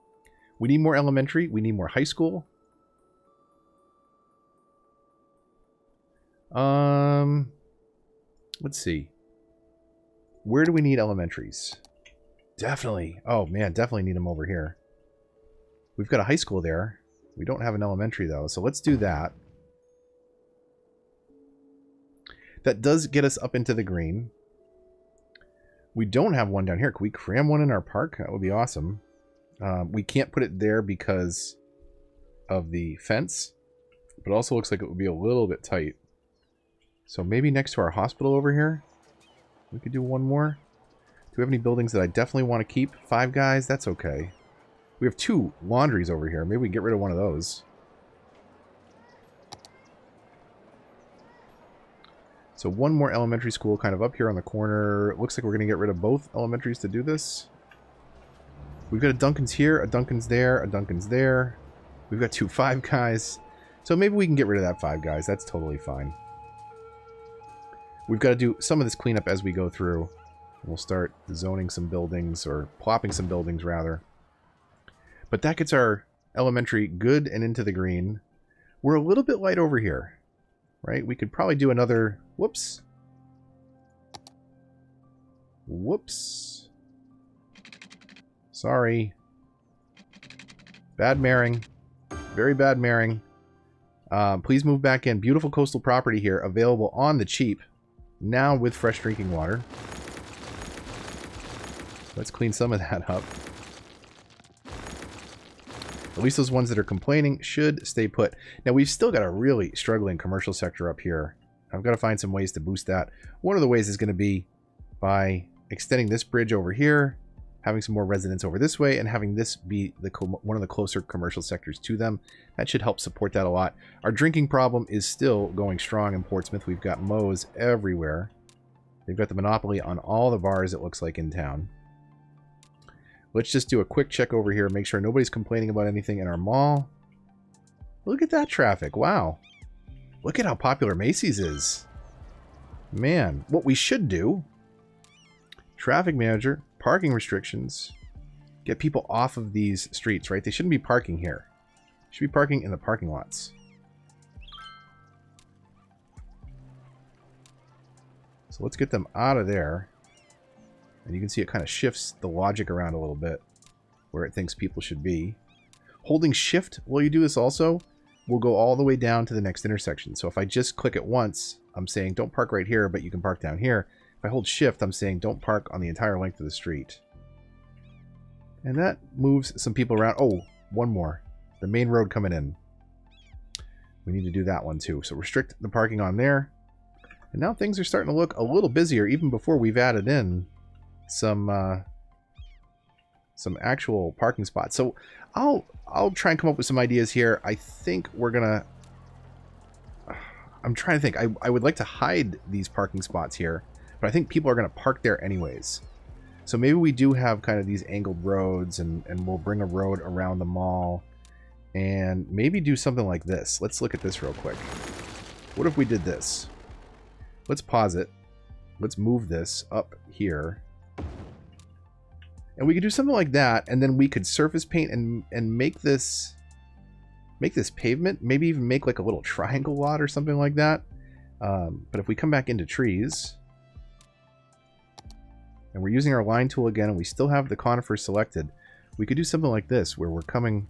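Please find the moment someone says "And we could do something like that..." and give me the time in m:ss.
3:42.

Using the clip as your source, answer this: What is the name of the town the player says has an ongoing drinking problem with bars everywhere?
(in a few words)
Portsmouth.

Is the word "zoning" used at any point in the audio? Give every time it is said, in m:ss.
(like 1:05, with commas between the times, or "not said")
1:11.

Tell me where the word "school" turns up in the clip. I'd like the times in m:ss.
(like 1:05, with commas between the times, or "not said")
0:02, 0:16, 0:53.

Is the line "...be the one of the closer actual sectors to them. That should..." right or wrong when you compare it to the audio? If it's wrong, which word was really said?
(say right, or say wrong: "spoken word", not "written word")
wrong: "commercial", not "actual".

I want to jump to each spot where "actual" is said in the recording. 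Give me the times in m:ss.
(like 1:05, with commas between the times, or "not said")
3:13.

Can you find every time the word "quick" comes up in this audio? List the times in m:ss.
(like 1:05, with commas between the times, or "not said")
2:13, 3:34.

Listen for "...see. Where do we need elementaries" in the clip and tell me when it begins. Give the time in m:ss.
0:08.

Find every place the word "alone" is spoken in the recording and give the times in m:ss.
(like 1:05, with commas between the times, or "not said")
not said.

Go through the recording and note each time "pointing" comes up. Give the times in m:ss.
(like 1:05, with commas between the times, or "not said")
not said.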